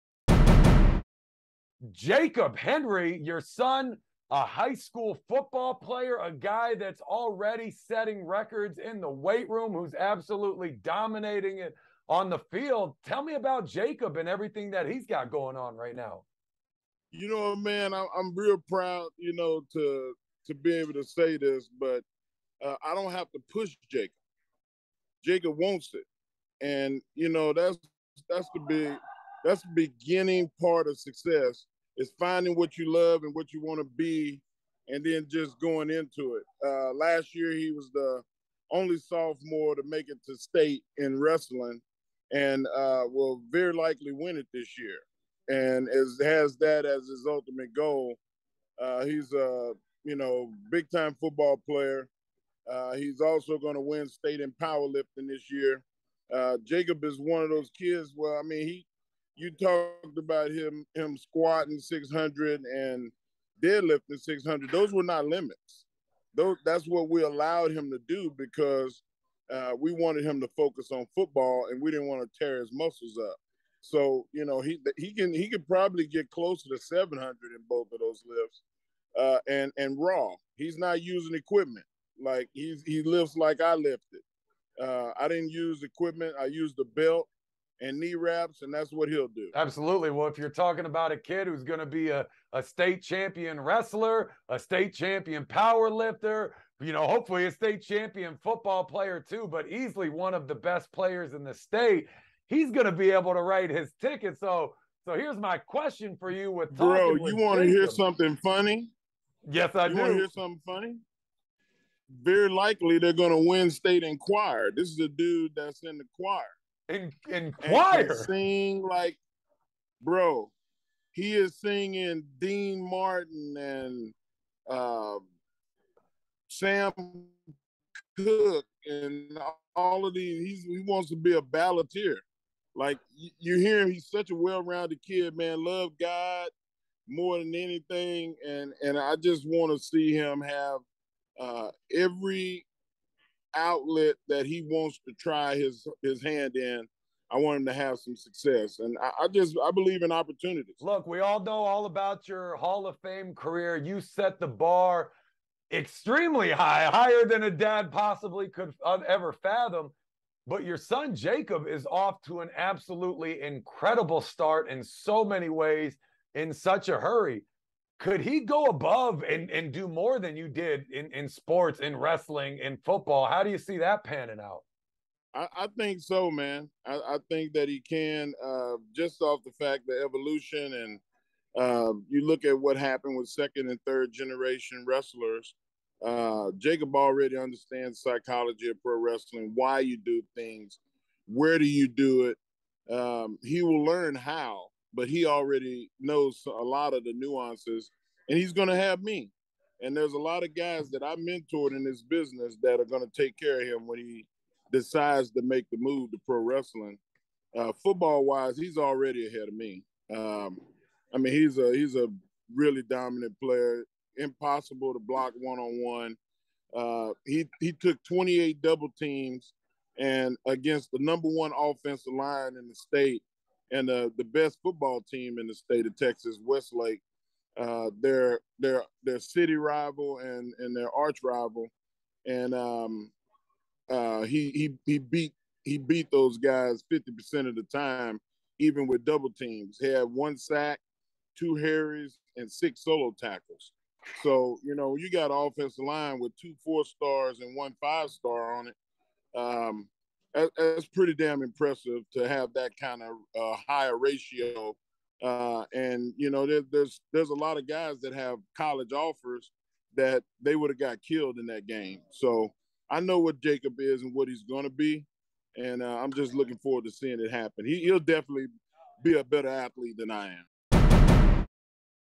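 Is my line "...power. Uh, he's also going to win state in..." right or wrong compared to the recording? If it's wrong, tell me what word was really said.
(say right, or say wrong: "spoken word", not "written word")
wrong: "player", not "power".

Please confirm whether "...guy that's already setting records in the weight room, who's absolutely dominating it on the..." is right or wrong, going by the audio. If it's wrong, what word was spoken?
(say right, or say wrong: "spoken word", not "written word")
right.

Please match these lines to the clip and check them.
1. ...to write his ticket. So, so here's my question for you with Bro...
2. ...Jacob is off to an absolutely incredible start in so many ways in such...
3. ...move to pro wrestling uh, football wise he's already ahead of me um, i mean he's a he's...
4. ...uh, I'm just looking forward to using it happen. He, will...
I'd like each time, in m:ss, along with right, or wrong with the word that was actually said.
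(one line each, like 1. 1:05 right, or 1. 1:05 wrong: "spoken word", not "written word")
1. 1:43 right
2. 2:41 right
3. 3:25 right
4. 4:25 wrong: "seeing", not "using".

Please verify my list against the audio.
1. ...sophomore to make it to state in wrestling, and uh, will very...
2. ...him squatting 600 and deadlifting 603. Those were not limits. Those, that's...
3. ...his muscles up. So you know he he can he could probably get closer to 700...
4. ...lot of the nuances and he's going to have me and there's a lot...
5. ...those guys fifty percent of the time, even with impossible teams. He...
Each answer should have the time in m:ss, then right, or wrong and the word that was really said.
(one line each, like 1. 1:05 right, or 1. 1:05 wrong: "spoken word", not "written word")
1. 0:38 right
2. 1:00 wrong: "600", not "603"
3. 1:12 right
4. 3:16 right
5. 3:56 wrong: "double", not "impossible".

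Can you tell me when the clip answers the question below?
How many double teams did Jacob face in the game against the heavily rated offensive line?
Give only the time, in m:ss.
3:38.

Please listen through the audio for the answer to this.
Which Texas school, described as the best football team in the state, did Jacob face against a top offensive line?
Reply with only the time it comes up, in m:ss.
3:46.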